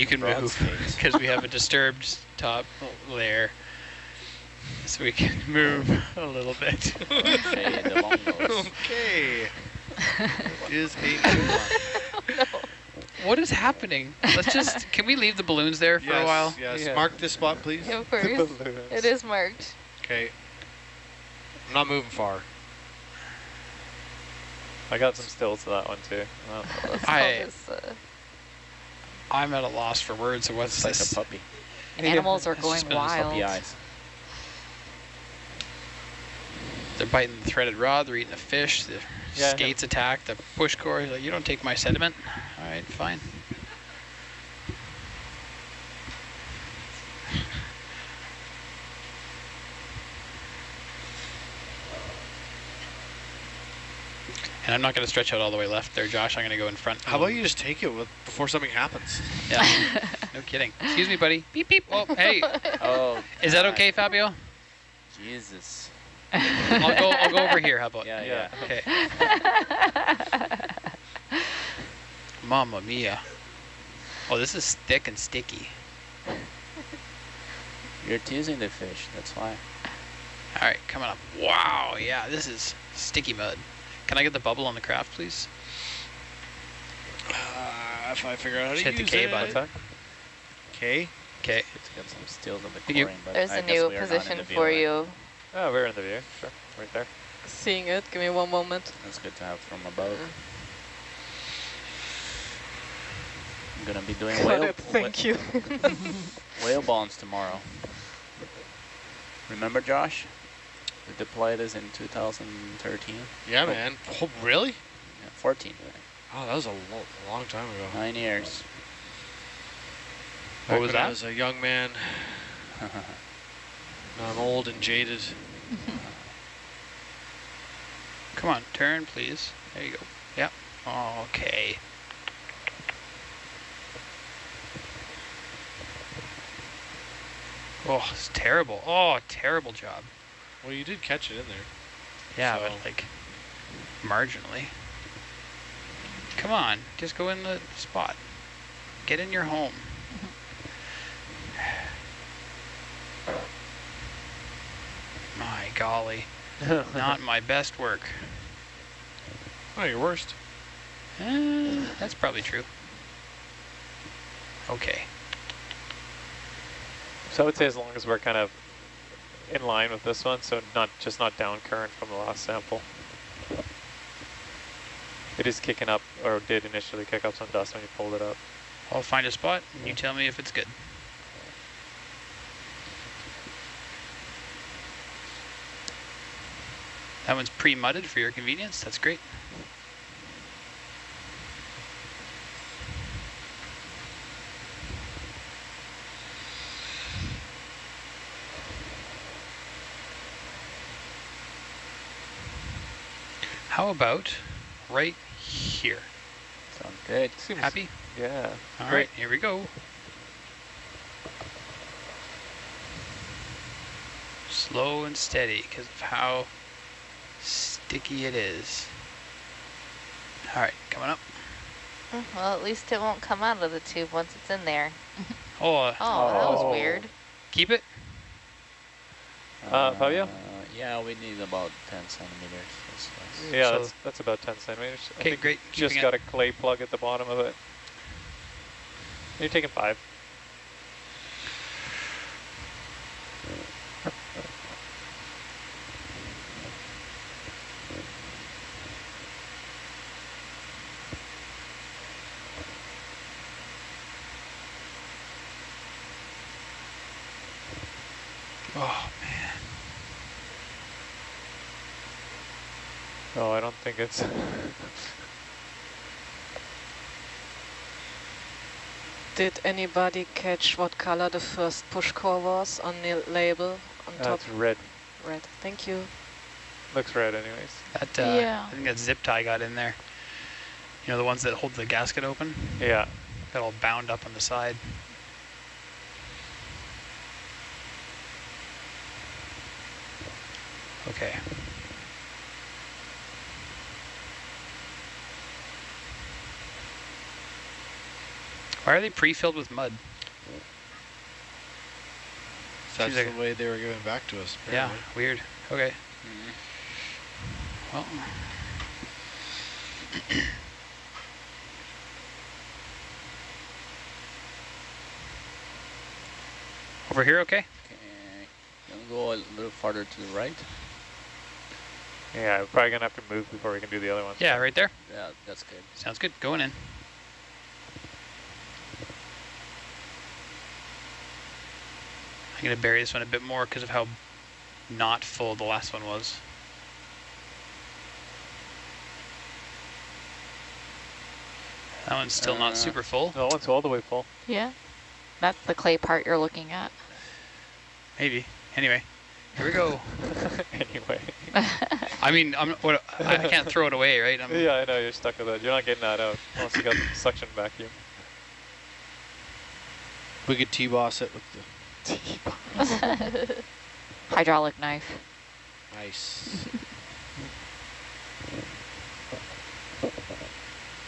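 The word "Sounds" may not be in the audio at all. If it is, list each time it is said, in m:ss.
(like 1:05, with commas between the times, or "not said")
3:26, 5:25.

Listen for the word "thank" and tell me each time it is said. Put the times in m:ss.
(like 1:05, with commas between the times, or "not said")
1:44, 4:35.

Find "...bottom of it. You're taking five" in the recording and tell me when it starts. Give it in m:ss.
3:56.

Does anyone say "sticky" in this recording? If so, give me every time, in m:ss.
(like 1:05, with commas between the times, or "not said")
1:15, 1:22, 3:37.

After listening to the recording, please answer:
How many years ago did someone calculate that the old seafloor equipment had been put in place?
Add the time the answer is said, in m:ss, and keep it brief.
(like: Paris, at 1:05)
9, at 1:57.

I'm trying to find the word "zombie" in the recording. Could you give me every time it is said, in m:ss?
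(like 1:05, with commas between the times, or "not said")
not said.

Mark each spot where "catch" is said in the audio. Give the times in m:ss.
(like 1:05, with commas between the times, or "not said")
2:21, 4:30.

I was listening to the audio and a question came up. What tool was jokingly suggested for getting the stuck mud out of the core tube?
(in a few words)
Hydraulic knife.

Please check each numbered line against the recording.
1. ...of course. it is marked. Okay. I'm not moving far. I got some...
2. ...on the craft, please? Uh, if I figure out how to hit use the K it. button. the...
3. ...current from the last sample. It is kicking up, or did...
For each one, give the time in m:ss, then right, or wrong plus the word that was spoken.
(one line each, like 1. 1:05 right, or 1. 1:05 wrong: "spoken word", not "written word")
1. 0:17 right
2. 1:24 right
3. 2:51 right.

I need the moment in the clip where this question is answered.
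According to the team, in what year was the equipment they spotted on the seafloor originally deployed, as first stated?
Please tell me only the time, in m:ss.
1:51.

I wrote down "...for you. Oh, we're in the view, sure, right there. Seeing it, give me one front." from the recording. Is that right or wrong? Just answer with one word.
wrong.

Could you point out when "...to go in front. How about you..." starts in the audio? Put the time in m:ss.
0:56.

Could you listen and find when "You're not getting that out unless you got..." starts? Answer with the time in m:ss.
5:55.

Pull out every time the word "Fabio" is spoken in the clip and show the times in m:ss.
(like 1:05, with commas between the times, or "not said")
1:03, 3:49.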